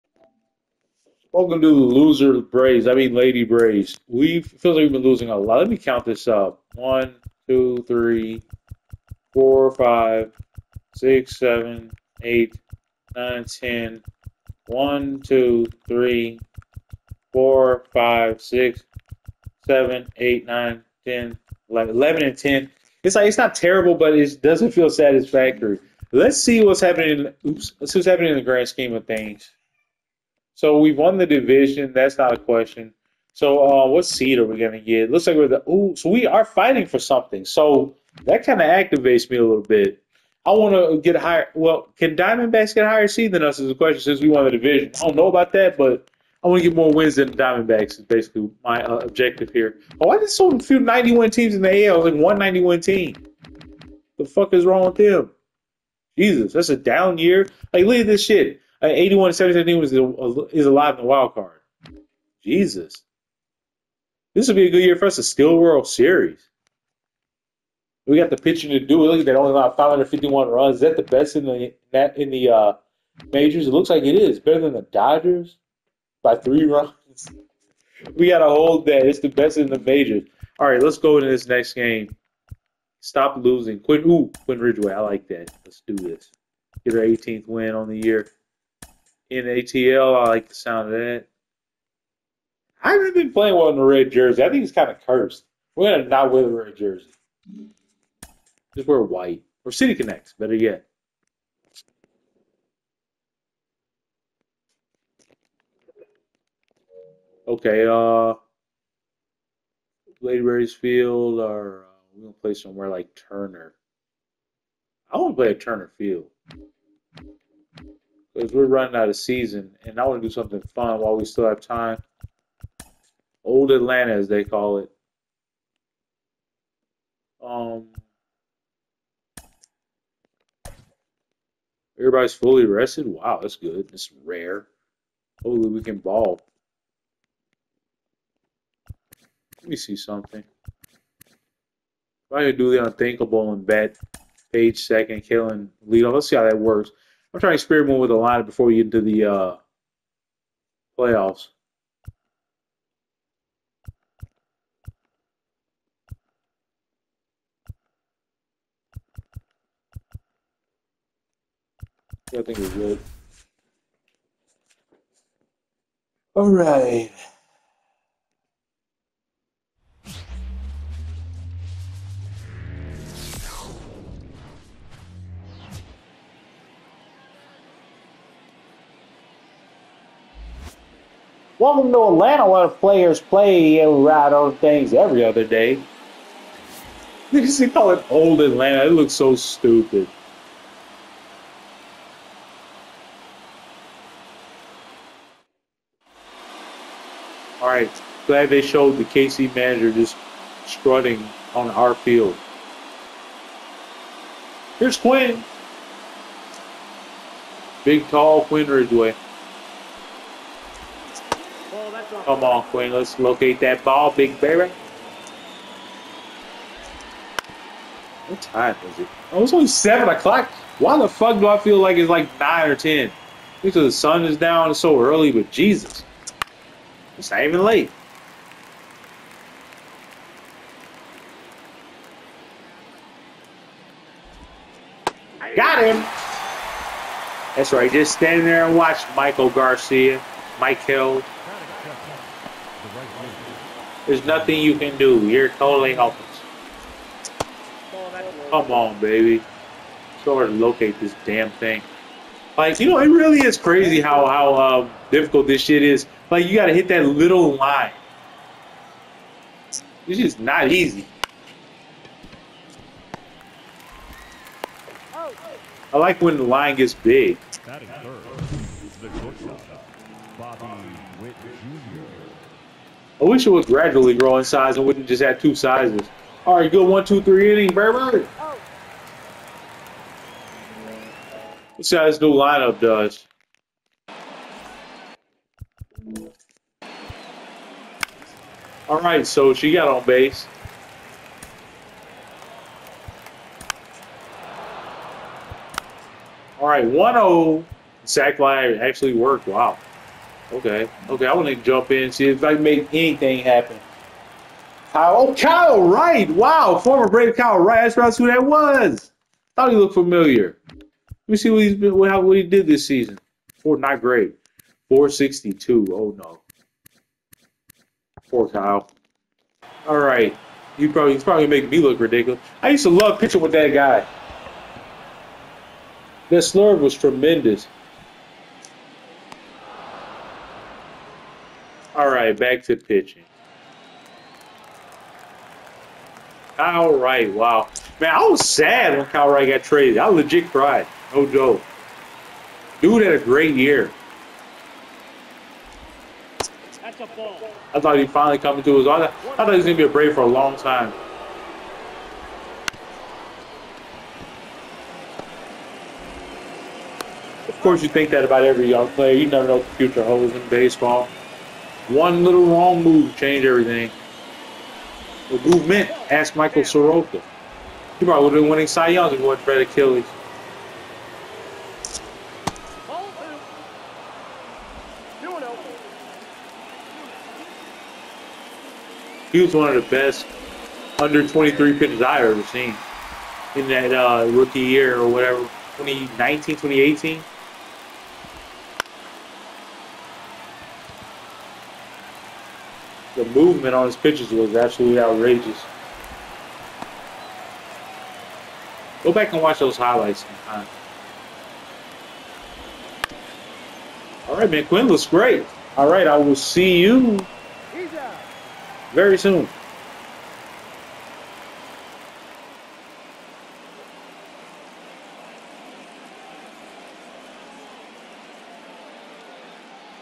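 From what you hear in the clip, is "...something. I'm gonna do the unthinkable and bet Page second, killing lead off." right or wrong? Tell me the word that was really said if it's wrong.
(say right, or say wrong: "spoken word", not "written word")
right.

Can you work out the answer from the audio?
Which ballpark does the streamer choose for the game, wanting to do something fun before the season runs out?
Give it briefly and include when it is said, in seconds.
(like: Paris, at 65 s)
Turner Field, at 115 s.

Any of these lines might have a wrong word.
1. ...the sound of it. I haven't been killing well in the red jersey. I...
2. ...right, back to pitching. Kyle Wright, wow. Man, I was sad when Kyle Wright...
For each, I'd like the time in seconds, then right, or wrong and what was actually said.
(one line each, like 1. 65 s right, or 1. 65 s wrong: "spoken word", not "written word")
1. 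90 s wrong: "playing", not "killing"
2. 332 s right.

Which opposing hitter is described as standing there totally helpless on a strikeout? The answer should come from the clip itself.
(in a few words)
Maikel Garcia.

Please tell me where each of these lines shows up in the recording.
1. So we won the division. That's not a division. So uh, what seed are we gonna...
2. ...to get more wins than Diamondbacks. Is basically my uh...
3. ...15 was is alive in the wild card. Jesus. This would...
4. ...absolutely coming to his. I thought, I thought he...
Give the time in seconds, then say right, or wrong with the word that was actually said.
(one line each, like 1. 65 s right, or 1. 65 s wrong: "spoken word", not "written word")
1. 30 s wrong: "question", not "division"
2. 46 s right
3. 59 s wrong: "17", not "15"
4. 348 s wrong: "finally", not "absolutely".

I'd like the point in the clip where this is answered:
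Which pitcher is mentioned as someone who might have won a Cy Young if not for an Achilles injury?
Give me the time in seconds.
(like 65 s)
366 s.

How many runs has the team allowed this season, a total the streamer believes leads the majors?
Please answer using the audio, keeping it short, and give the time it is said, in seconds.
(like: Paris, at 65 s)
551, at 69 s.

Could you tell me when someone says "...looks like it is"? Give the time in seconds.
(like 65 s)
73 s.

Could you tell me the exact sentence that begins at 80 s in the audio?
All right, let's go into this next game.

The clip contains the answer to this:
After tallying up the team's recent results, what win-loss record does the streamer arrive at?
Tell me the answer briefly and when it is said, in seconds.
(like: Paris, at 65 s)
11 and 10, at 21 s.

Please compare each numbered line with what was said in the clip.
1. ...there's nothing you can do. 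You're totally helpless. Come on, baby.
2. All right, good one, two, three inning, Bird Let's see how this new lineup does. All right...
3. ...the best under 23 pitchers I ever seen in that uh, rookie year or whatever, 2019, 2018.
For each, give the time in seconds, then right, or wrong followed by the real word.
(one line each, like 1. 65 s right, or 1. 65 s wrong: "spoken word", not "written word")
1. 244 s right
2. 276 s right
3. 379 s right.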